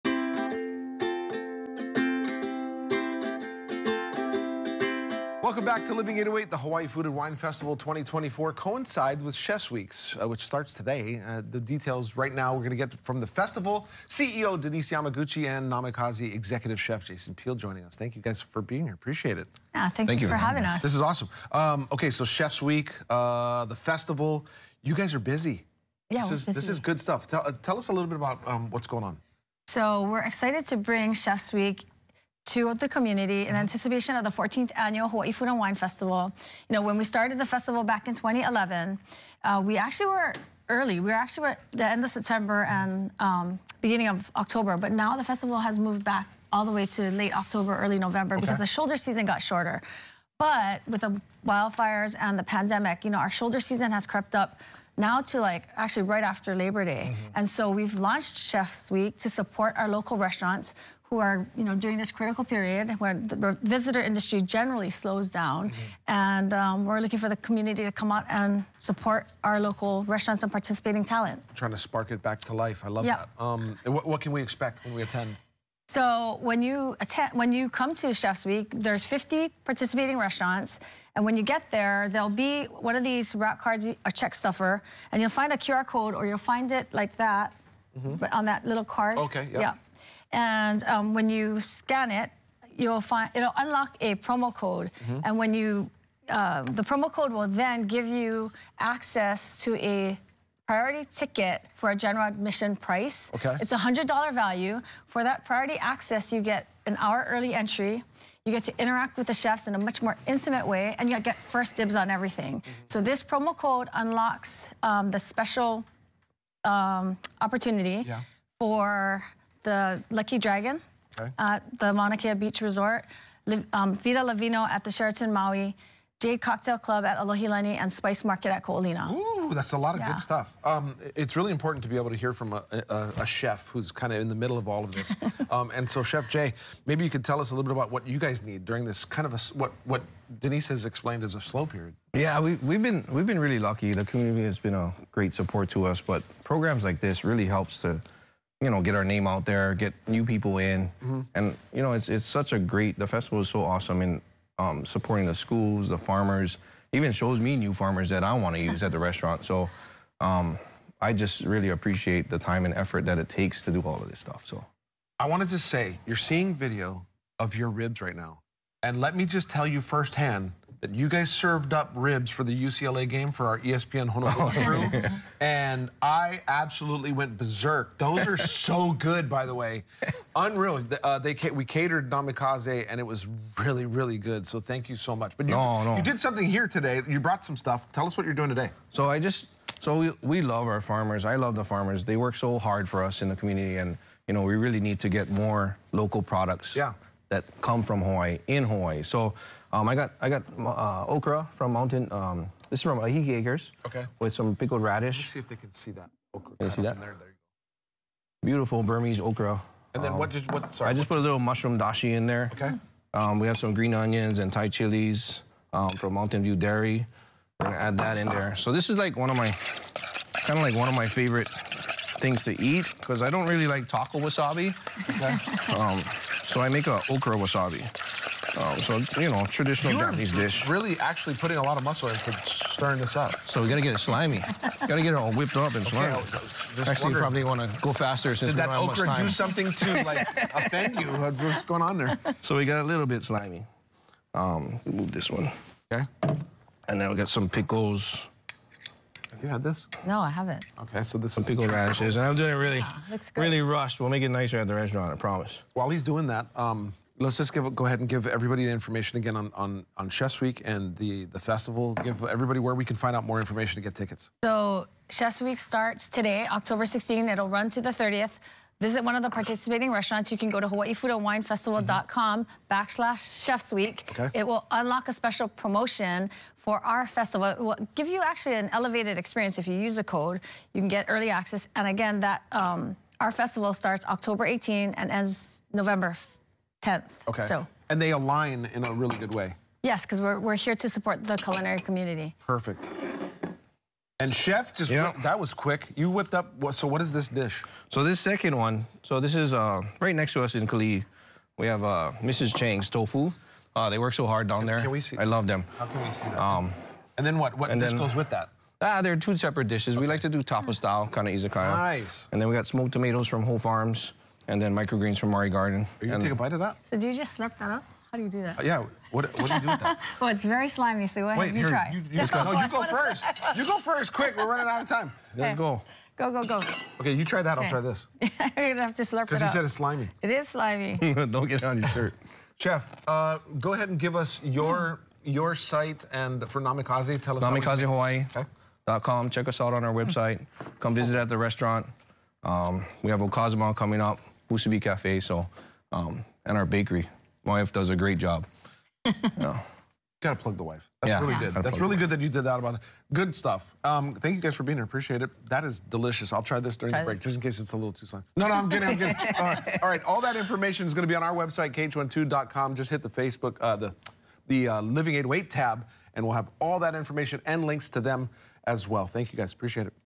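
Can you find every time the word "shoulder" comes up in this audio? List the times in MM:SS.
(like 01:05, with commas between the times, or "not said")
00:48, 00:53.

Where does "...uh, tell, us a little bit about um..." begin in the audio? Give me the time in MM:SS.
00:27.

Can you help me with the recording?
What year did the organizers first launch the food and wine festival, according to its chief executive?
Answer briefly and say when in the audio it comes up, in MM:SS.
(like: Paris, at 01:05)
2011, at 00:38.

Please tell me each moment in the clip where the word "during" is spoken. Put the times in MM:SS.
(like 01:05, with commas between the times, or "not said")
01:01, 02:18, 05:56.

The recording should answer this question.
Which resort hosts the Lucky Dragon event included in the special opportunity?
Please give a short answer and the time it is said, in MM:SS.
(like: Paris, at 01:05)
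Mauna Kea Beach Resort, at 02:01.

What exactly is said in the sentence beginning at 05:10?
We like to do tapa style, kind of izakaya.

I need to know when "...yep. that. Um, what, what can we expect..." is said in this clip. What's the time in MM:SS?
01:13.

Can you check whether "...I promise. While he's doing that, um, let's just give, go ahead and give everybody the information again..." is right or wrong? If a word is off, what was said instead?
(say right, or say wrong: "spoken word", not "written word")
right.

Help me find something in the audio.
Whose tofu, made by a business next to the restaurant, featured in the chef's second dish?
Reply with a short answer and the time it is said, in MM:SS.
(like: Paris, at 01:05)
Mrs. Cheng's, at 05:02.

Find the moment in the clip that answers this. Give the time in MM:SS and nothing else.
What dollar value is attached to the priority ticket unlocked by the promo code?
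01:43.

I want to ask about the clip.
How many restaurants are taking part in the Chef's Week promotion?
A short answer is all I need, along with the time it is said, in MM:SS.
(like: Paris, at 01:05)
50, at 01:19.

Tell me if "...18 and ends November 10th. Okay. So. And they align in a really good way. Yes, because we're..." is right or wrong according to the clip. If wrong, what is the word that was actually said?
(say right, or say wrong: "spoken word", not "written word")
right.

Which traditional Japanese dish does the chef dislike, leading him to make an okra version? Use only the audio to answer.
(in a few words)
tako wasabi.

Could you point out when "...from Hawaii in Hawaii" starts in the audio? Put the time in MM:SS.
03:17.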